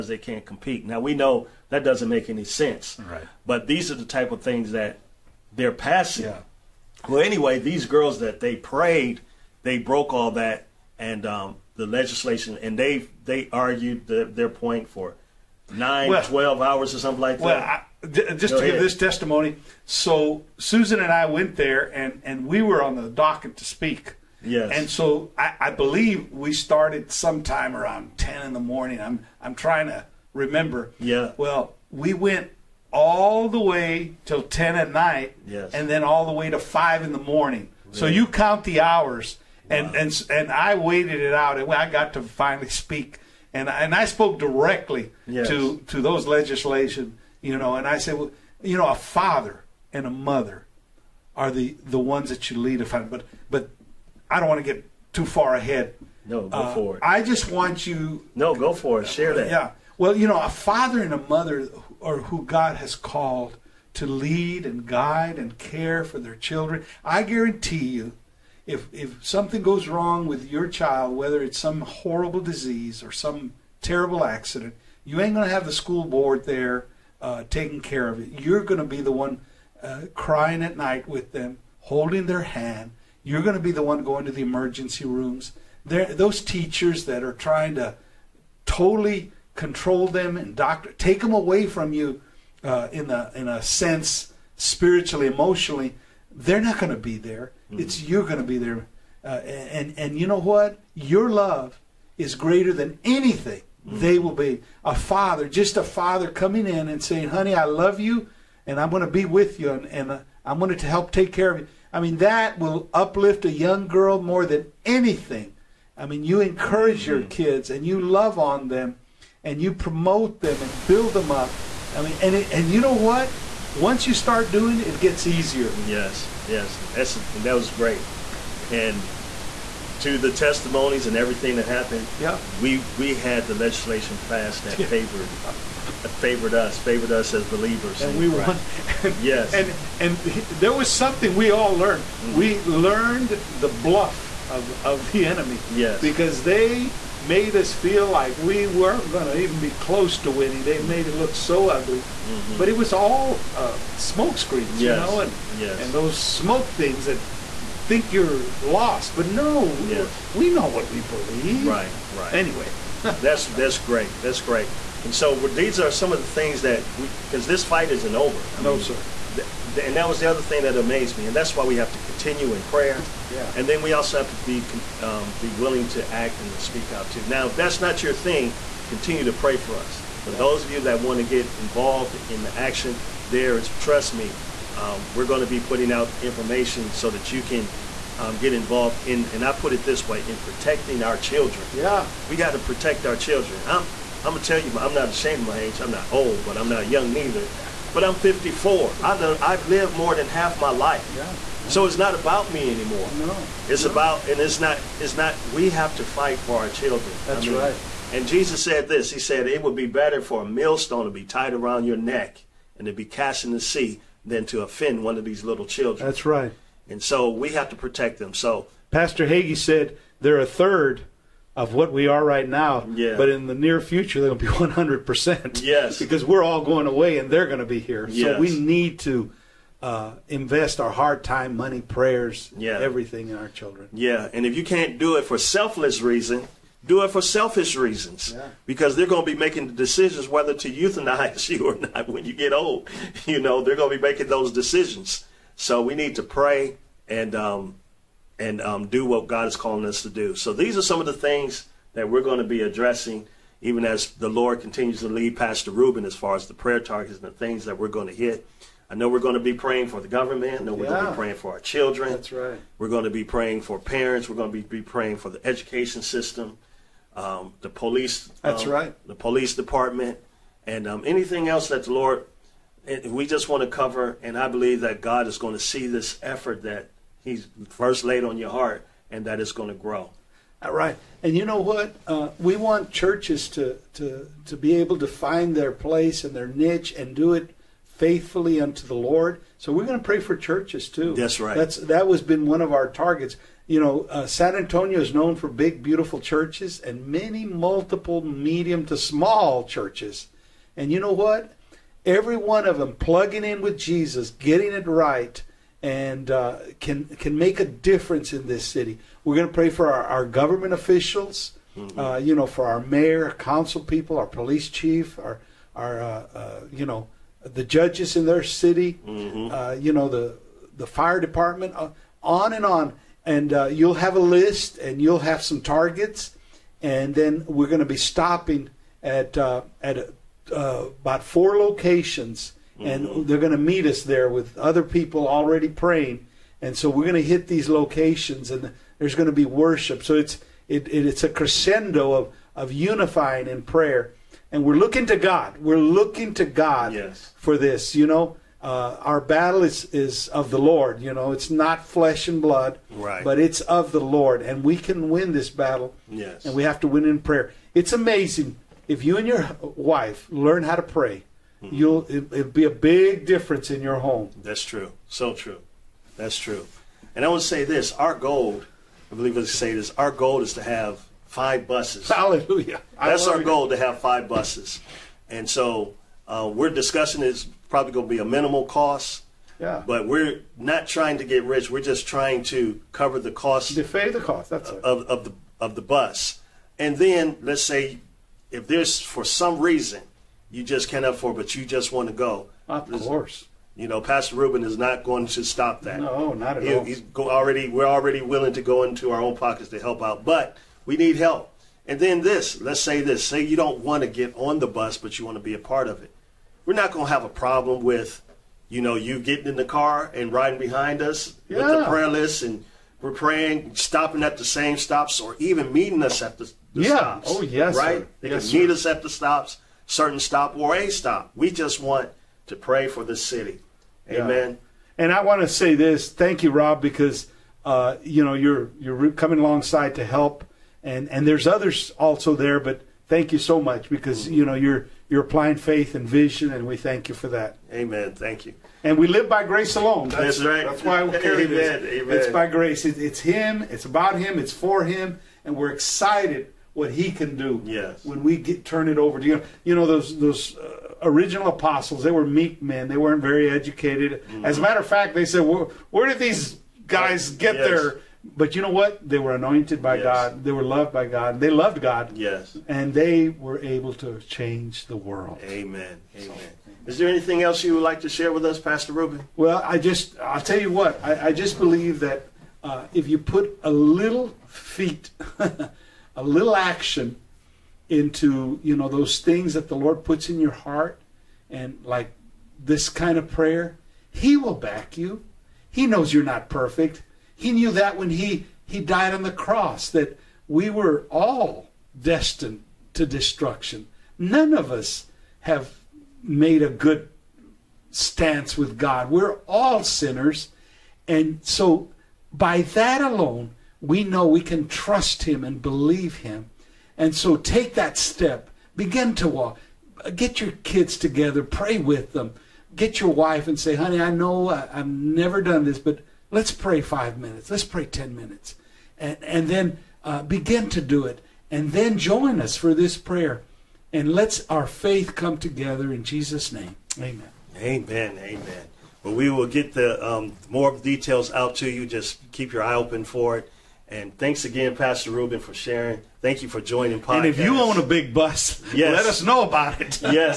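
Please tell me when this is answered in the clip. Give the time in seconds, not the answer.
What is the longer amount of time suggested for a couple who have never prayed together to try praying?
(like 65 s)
517 s.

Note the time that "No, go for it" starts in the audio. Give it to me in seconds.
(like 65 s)
58 s.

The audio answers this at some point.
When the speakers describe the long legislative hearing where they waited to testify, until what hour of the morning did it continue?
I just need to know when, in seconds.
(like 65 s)
36 s.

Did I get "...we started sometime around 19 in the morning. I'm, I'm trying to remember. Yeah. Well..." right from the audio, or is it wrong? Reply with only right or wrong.
wrong.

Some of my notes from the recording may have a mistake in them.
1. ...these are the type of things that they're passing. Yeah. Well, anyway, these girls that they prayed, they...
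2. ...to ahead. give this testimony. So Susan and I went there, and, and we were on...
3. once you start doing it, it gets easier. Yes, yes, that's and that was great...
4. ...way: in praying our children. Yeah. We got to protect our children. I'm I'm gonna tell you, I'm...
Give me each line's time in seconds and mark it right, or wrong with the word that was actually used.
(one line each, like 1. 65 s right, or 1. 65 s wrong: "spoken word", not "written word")
1. 3 s right
2. 18 s right
3. 123 s right
4. 190 s wrong: "protecting", not "praying".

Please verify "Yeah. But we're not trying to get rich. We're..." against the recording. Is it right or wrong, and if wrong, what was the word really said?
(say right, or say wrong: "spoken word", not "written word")
right.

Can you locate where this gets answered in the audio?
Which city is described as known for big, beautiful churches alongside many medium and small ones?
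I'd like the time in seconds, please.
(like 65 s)
294 s.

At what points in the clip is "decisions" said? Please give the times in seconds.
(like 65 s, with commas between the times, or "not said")
239 s, 244 s.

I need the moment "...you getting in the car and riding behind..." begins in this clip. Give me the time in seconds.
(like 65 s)
408 s.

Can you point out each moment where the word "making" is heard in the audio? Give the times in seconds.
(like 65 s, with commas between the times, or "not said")
239 s, 244 s.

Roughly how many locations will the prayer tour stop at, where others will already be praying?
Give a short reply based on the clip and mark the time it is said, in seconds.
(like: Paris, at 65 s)
4, at 331 s.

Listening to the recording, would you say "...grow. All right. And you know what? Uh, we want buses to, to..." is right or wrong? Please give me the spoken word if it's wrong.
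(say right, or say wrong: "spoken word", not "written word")
wrong: "churches", not "buses".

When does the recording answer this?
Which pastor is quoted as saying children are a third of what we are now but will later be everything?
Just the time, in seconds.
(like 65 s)
218 s.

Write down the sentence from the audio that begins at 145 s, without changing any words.
Yes, because they made us feel like we weren't going to even be close to winning.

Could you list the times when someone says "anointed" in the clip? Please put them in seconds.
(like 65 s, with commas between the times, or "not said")
459 s.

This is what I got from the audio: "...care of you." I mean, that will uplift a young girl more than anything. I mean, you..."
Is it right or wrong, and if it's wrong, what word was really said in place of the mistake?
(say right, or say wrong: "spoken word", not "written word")
right.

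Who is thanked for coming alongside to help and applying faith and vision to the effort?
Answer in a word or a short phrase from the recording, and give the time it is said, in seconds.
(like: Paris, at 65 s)
Rob, at 426 s.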